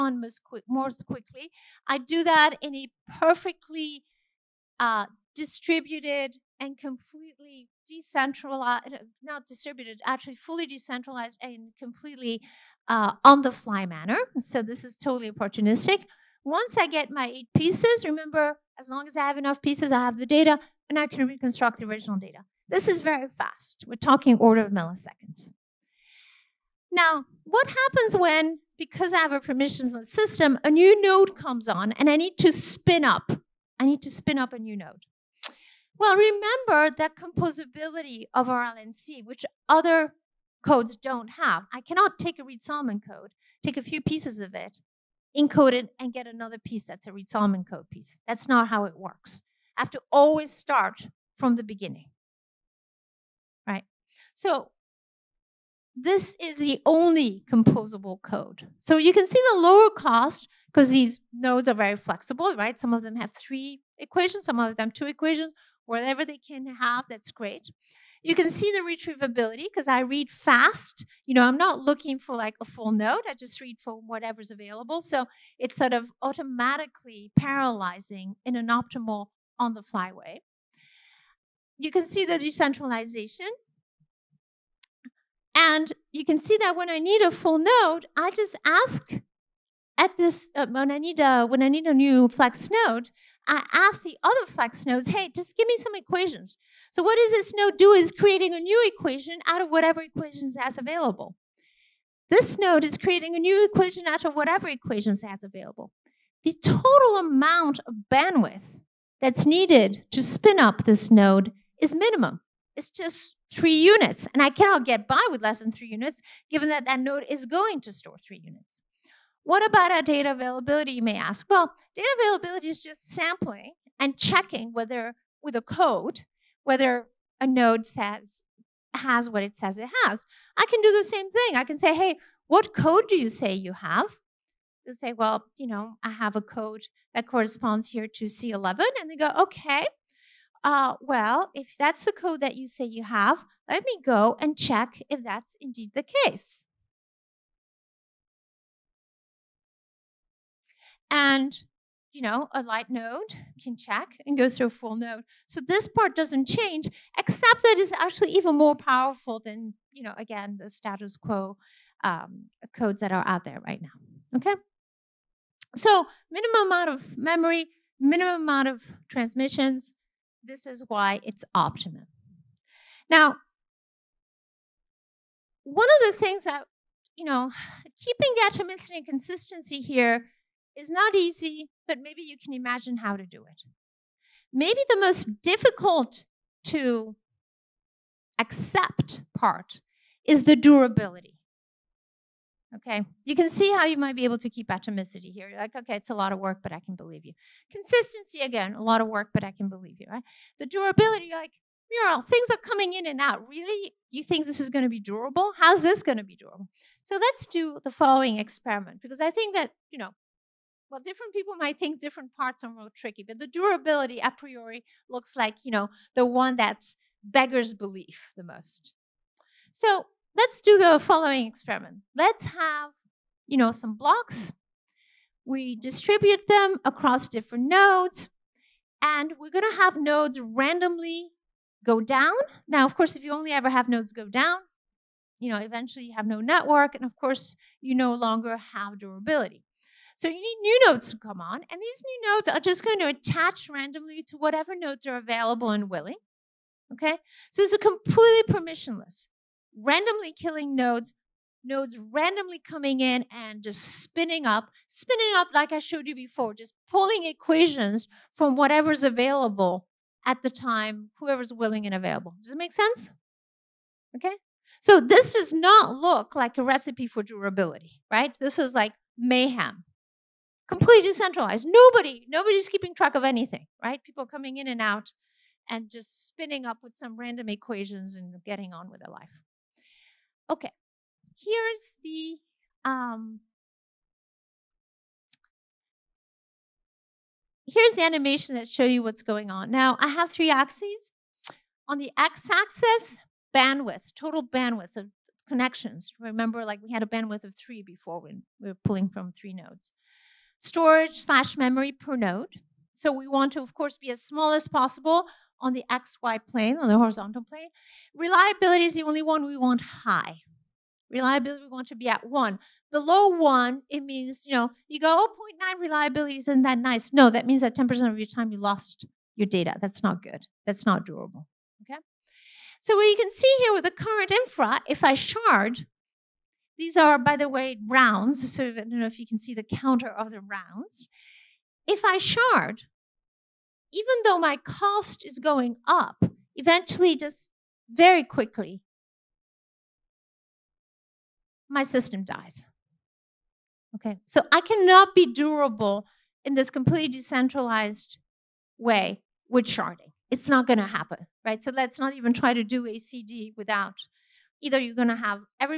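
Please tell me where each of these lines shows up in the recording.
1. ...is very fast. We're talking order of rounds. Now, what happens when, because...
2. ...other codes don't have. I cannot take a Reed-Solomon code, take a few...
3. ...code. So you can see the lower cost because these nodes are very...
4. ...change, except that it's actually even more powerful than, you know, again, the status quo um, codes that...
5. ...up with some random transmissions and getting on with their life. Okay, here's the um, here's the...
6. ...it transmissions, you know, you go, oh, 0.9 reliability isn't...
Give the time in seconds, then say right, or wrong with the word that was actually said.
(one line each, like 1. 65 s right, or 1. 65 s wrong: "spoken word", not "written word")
1. 22 s wrong: "milliseconds", not "rounds"
2. 39 s right
3. 58 s right
4. 156 s right
5. 276 s wrong: "equations", not "transmissions"
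6. 313 s wrong: "means", not "transmissions".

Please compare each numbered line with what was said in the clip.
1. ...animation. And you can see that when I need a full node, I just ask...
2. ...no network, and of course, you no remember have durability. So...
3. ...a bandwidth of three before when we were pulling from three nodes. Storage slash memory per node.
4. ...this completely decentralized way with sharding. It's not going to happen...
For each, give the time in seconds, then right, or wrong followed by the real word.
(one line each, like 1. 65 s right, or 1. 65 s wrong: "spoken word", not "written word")
1. 82 s wrong: "decentralization", not "animation"
2. 236 s wrong: "longer", not "remember"
3. 297 s right
4. 346 s right.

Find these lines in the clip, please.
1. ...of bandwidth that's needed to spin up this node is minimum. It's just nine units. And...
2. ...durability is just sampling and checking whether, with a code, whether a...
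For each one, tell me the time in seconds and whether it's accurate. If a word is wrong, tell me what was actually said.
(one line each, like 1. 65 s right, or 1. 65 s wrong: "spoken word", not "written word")
1. 107 s wrong: "three", not "nine"
2. 122 s wrong: "availability", not "durability".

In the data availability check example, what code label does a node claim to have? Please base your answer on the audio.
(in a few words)
C11.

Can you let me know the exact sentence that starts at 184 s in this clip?
Maybe the most difficult to accept part is the durability.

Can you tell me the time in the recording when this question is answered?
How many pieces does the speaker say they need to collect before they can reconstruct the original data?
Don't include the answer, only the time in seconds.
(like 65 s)
17 s.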